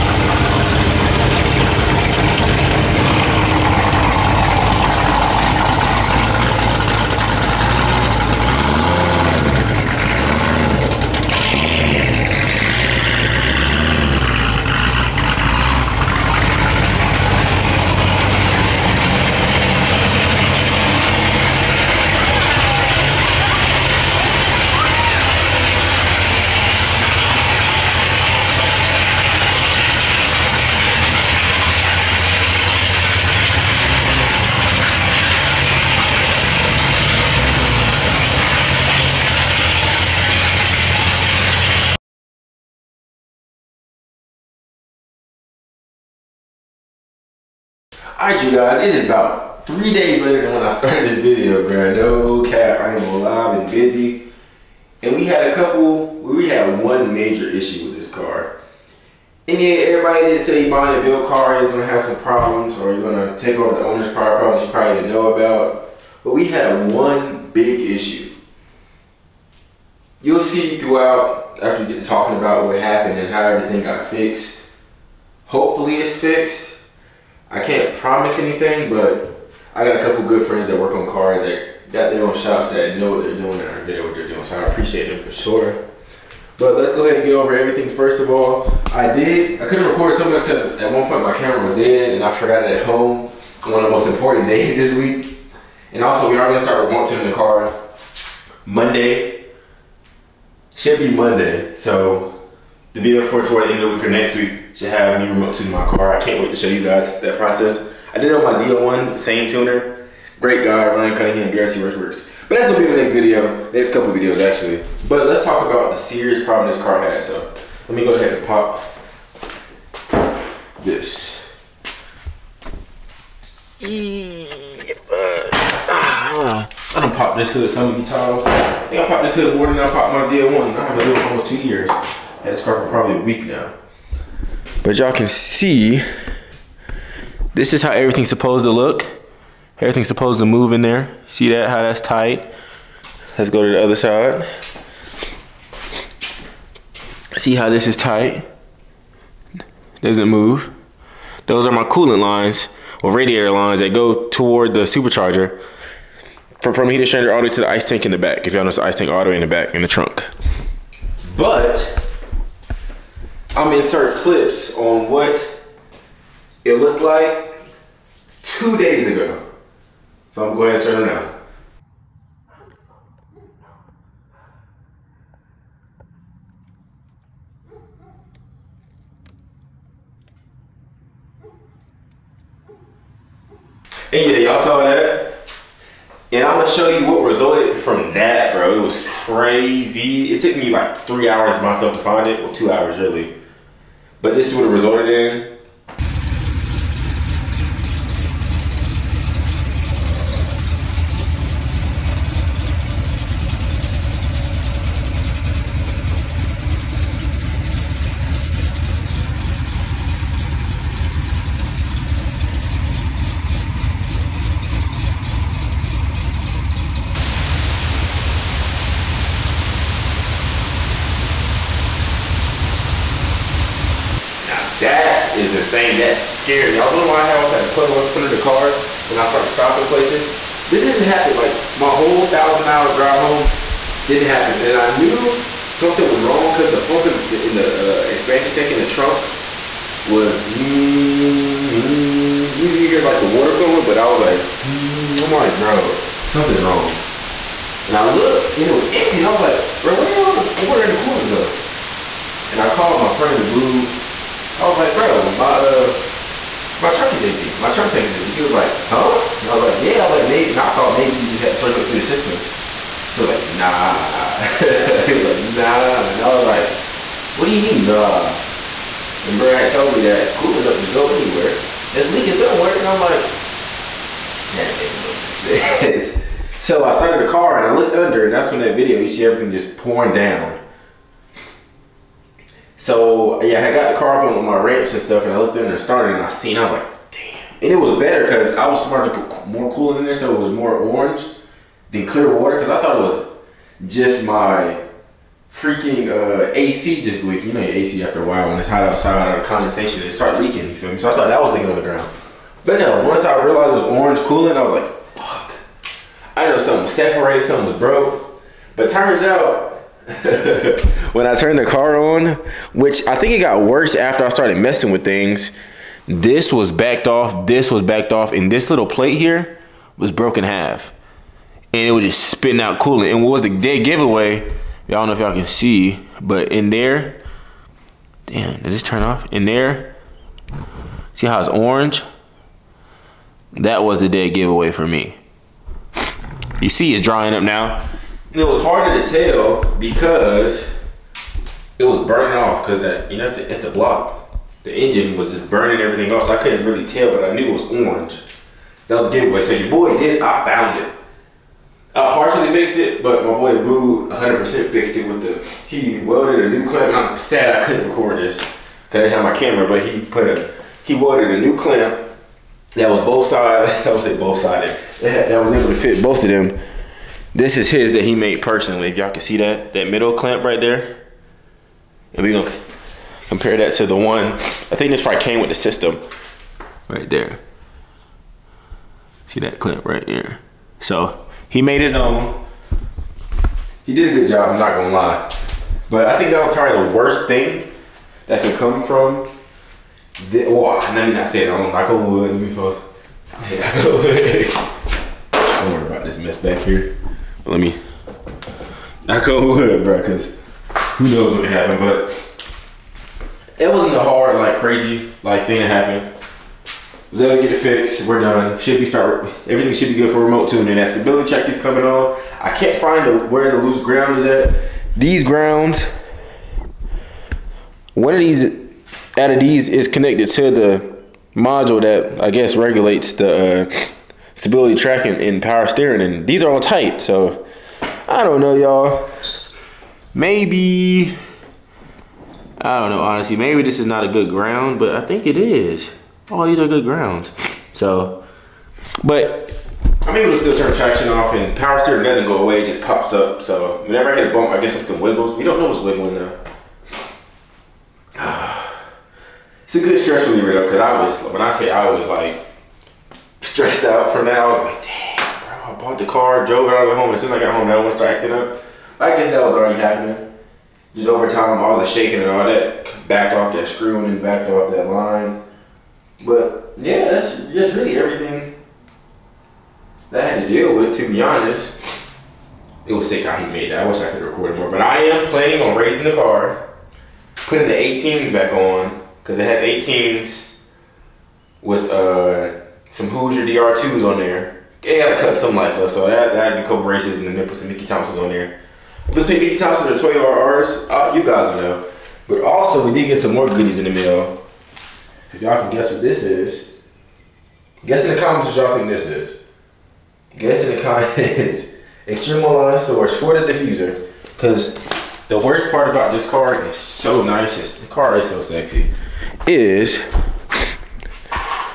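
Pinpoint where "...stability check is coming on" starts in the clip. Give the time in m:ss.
6:50.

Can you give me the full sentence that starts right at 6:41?
But it wasn't a hard, like crazy, like thing that happened.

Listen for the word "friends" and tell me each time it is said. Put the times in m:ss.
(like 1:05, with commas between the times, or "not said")
1:20, 4:13.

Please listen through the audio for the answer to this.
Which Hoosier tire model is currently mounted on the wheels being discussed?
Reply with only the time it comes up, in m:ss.
8:03.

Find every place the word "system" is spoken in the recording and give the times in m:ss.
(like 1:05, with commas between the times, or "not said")
4:22, 6:15.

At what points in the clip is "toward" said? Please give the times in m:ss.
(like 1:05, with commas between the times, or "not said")
1:43, 2:34.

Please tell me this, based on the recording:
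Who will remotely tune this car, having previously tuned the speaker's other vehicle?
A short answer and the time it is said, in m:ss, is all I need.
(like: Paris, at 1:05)
Ryan Cunningham, at 1:50.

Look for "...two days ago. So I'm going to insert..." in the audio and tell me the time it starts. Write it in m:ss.
2:48.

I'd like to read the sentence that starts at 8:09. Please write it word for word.
Between Mickey Thompson and Toyota RRs, uh, you guys will know.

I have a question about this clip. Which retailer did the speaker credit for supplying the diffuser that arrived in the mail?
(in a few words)
Extreme Online Stores.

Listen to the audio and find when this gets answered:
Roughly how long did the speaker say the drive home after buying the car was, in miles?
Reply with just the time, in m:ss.
3:52.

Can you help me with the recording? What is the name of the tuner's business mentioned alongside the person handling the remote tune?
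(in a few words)
BRC Works.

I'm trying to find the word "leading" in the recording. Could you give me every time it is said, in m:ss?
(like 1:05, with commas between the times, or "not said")
not said.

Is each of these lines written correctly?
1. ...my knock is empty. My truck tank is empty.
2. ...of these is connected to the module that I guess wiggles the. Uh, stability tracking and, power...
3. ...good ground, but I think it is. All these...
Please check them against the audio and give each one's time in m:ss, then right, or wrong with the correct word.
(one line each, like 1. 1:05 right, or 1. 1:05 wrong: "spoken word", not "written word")
1. 4:16 wrong: "truck", not "knock"
2. 6:59 wrong: "regulates", not "wiggles"
3. 7:14 right.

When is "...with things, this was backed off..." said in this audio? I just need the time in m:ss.
5:14.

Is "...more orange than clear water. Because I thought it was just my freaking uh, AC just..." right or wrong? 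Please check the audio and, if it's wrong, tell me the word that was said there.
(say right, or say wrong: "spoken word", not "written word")
right.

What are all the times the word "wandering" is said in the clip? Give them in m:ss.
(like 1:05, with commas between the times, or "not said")
not said.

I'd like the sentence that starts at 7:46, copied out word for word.
But yeah, that's just really everything that I had to deal with.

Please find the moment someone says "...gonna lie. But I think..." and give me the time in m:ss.
6:24.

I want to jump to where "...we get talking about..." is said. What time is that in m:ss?
1:11.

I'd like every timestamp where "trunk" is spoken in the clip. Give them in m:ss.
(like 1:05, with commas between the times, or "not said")
2:39, 3:58.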